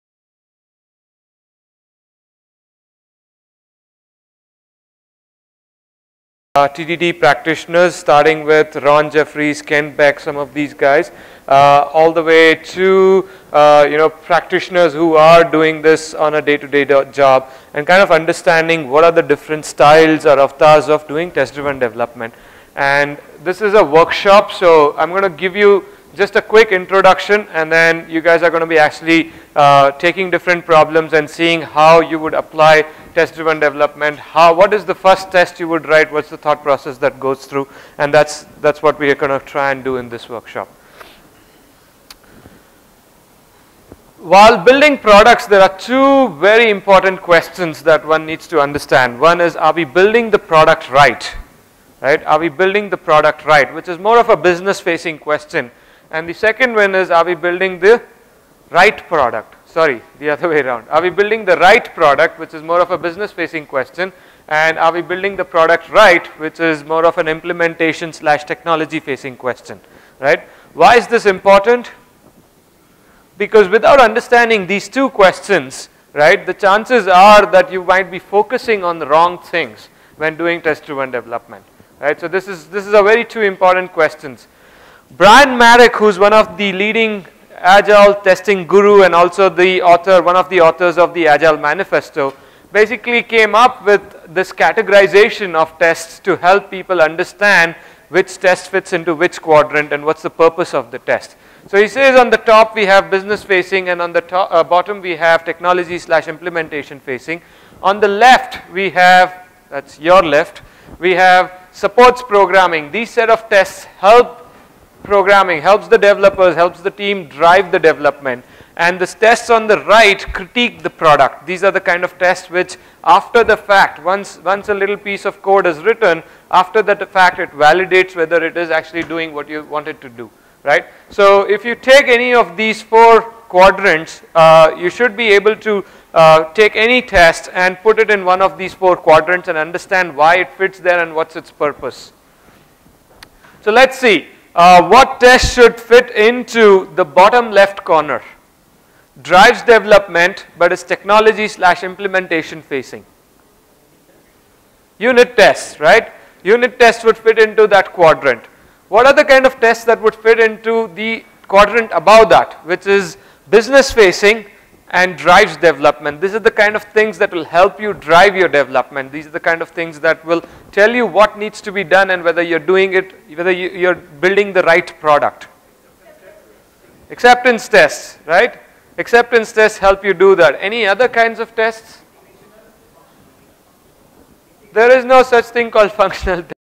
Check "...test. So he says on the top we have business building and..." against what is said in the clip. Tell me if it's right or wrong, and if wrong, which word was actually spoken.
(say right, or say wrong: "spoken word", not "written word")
wrong: "facing", not "building".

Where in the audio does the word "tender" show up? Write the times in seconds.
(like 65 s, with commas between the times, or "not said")
not said.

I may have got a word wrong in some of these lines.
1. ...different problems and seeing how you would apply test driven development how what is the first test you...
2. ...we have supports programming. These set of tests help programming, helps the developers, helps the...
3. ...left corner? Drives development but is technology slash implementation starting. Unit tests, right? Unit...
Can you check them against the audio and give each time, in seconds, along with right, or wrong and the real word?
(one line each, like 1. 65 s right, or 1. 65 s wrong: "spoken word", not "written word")
1. 30 s right
2. 110 s right
3. 147 s wrong: "facing", not "starting".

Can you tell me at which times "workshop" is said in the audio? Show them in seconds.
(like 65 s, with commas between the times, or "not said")
23 s, 40 s.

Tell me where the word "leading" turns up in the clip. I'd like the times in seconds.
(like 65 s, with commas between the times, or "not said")
86 s.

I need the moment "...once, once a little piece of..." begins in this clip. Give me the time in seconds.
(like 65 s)
124 s.